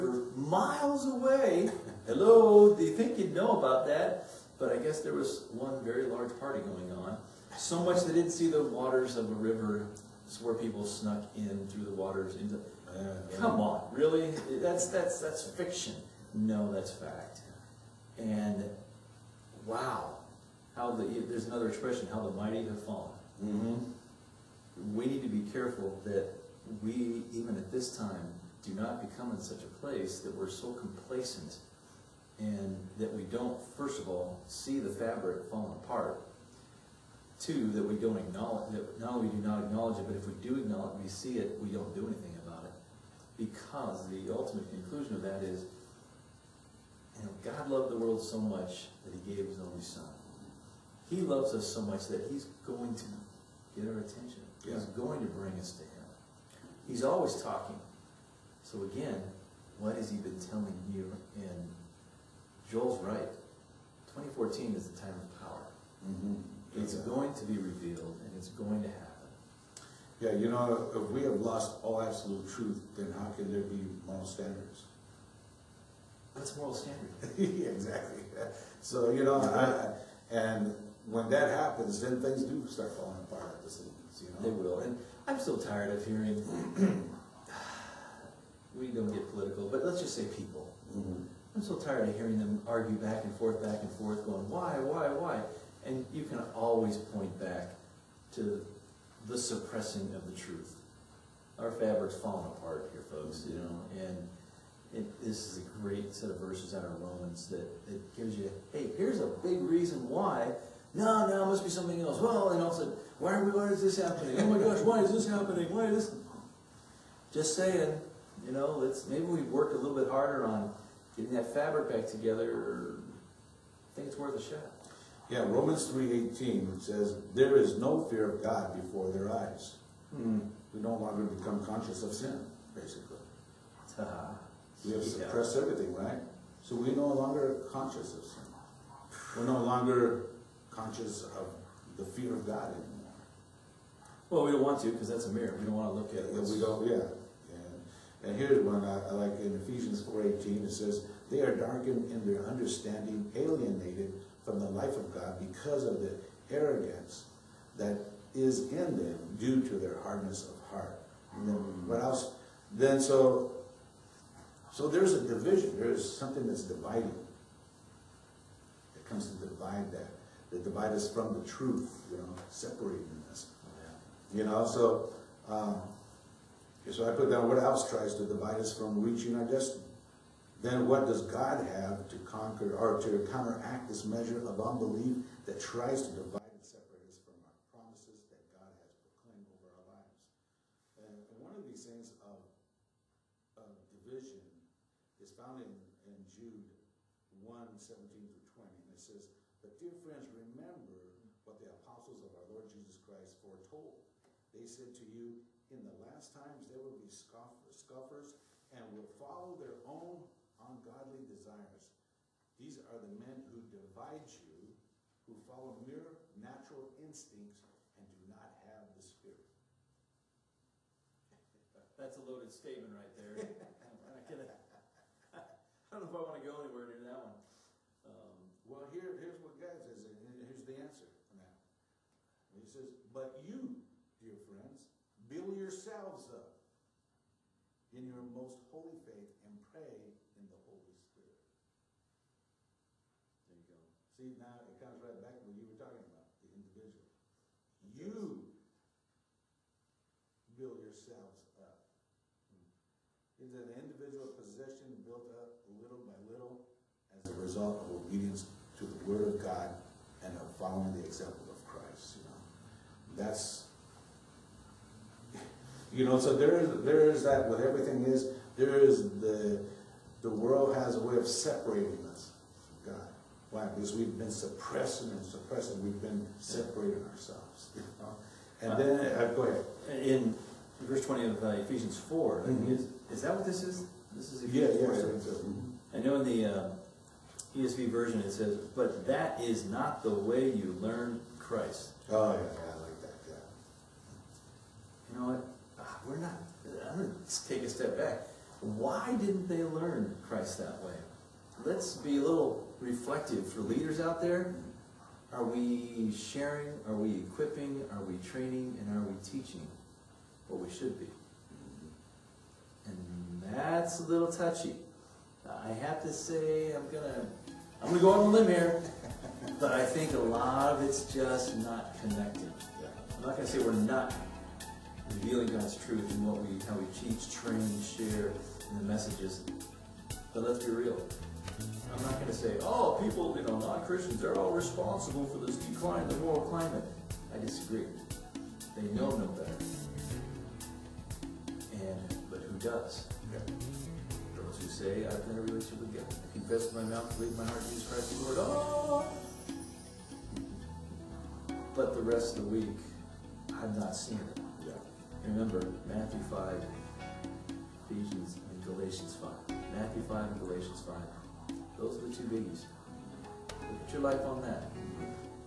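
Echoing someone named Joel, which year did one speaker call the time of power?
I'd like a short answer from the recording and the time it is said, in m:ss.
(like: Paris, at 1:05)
2014, at 1:04.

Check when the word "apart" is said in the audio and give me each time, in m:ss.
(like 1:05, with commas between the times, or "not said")
0:35, 1:23, 1:42.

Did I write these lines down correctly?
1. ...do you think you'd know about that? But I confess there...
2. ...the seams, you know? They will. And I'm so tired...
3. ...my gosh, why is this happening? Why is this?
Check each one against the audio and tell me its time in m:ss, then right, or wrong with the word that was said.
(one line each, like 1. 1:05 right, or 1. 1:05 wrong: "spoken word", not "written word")
1. 0:02 wrong: "guess", not "confess"
2. 1:23 right
3. 1:54 right.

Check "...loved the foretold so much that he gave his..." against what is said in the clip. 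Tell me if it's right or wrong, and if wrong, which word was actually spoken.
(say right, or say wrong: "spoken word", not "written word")
wrong: "world", not "foretold".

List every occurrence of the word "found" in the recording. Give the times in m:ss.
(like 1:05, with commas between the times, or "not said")
3:15.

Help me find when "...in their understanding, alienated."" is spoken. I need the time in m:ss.
2:32.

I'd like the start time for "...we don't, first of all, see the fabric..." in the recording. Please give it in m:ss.
0:33.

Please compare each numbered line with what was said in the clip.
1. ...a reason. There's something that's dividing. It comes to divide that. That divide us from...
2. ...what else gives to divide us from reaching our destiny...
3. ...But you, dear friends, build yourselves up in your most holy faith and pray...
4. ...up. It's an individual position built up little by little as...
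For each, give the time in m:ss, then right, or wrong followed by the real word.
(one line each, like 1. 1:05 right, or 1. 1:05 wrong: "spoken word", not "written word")
1. 2:45 wrong: "division", not "reason"
2. 2:57 wrong: "tries", not "gives"
3. 3:52 right
4. 4:11 right.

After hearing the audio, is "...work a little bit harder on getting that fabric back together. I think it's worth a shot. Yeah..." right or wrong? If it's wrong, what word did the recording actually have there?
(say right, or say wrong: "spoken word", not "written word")
right.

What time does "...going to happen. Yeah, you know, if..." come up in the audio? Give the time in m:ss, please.
1:08.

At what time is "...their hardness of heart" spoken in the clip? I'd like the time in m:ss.
2:39.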